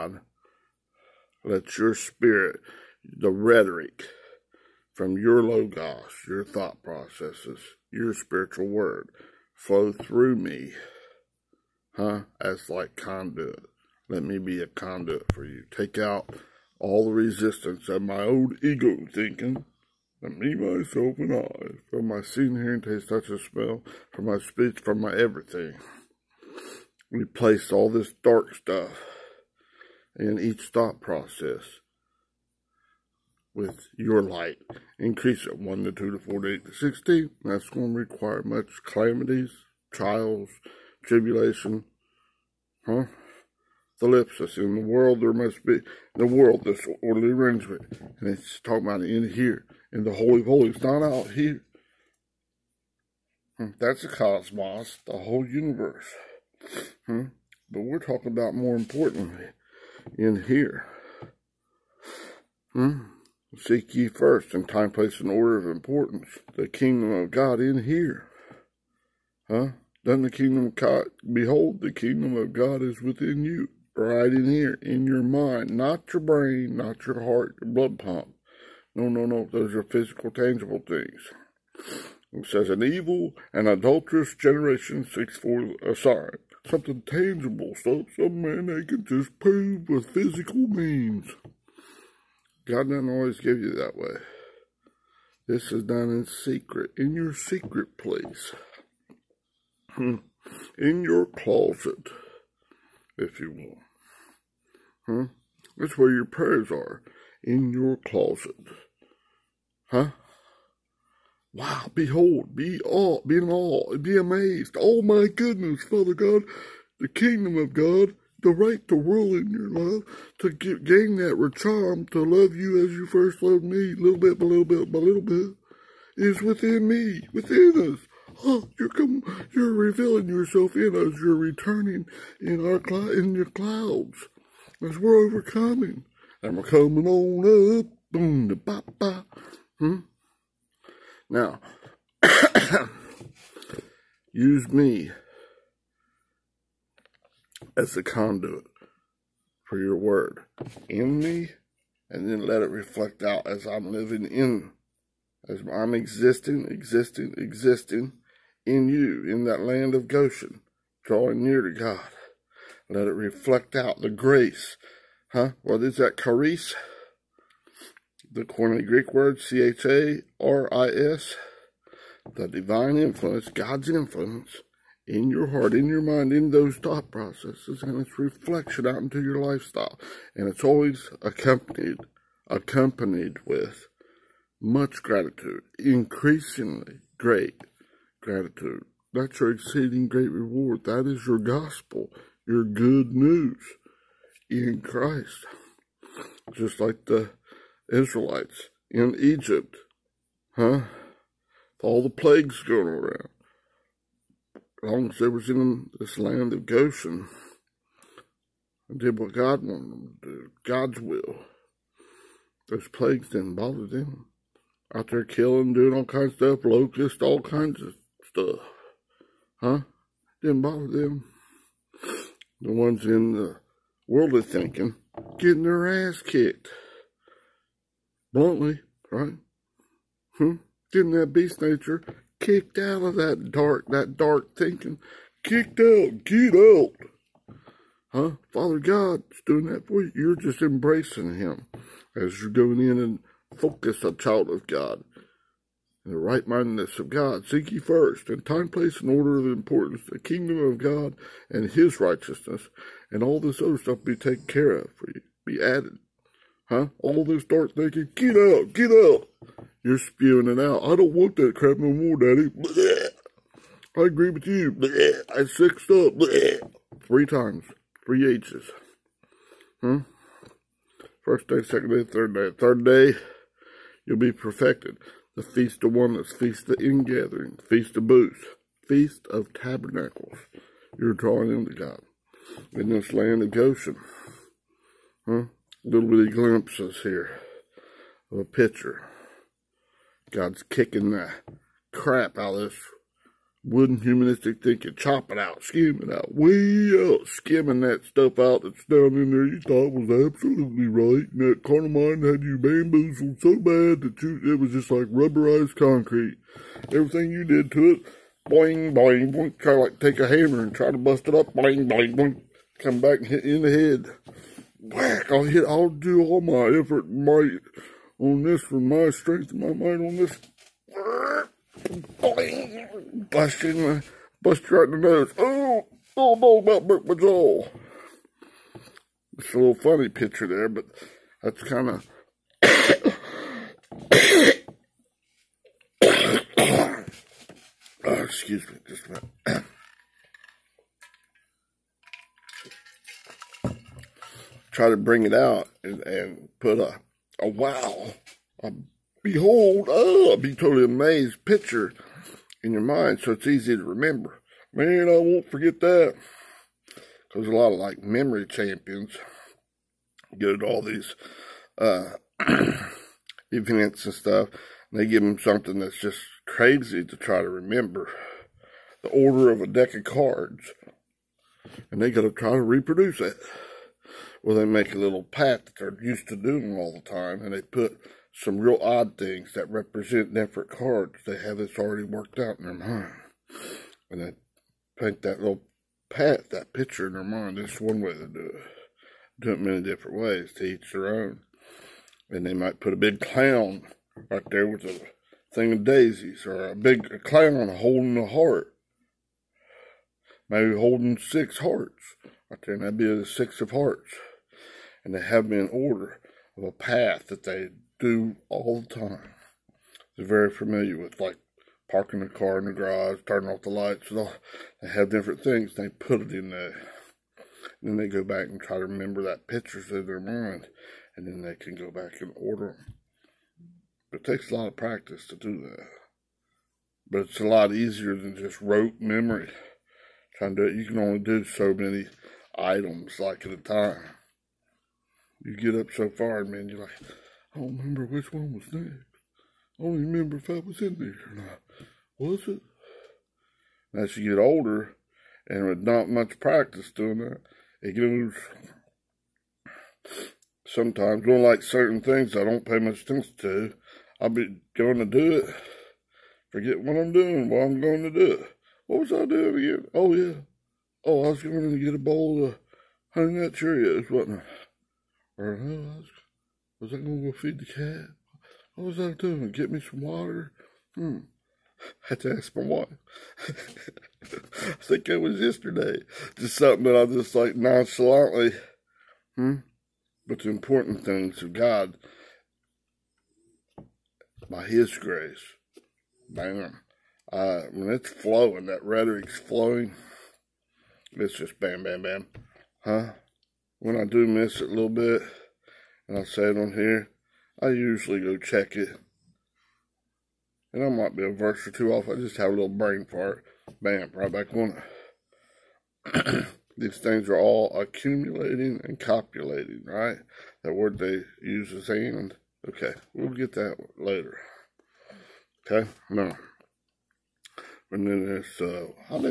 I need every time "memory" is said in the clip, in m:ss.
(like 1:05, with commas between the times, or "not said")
5:58, 7:09.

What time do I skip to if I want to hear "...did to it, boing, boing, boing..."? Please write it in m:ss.
5:07.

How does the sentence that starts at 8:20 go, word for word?
And I might be a verse or two off.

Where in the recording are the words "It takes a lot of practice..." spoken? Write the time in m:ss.
7:04.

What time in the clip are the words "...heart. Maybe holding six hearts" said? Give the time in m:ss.
6:38.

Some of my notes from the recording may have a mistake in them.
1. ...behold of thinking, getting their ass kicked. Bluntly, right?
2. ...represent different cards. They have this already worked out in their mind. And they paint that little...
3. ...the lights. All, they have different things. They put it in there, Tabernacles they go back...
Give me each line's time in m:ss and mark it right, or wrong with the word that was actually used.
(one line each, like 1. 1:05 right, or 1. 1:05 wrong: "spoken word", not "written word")
1. 3:44 wrong: "world", not "behold"
2. 6:19 right
3. 6:53 wrong: "Then", not "Tabernacles".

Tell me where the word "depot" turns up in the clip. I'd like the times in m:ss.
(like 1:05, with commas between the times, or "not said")
not said.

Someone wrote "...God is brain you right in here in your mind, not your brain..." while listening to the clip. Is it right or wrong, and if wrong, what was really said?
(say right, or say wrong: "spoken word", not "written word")
wrong: "within", not "brain".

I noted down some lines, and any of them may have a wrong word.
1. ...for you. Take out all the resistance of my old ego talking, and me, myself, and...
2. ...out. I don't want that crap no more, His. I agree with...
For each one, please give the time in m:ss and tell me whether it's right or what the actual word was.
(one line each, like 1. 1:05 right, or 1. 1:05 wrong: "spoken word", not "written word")
1. 0:15 wrong: "thinking", not "talking"
2. 4:20 wrong: "Daddy", not "His".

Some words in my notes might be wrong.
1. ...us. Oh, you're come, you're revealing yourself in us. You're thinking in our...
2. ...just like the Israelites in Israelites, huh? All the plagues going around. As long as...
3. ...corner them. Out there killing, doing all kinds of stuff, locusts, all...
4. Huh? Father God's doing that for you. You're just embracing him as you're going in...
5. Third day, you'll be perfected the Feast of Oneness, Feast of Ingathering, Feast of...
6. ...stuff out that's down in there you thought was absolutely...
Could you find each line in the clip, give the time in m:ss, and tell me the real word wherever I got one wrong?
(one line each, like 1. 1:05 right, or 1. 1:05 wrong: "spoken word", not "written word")
1. 2:07 wrong: "returning", not "thinking"
2. 3:16 wrong: "Egypt", not "Israelites"
3. 3:33 wrong: "bother", not "corner"
4. 3:58 right
5. 4:32 right
6. 4:58 right.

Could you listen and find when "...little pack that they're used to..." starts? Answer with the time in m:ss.
6:14.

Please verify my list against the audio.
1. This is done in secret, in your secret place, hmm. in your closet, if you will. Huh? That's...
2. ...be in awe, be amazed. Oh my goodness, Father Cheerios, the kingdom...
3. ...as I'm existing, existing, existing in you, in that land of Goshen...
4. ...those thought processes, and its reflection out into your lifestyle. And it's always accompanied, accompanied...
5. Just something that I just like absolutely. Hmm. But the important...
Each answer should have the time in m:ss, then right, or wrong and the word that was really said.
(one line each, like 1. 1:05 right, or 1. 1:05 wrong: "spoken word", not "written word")
1. 1:35 right
2. 1:53 wrong: "God", not "Cheerios"
3. 2:35 right
4. 2:56 right
5. 7:56 wrong: "nonchalantly", not "absolutely".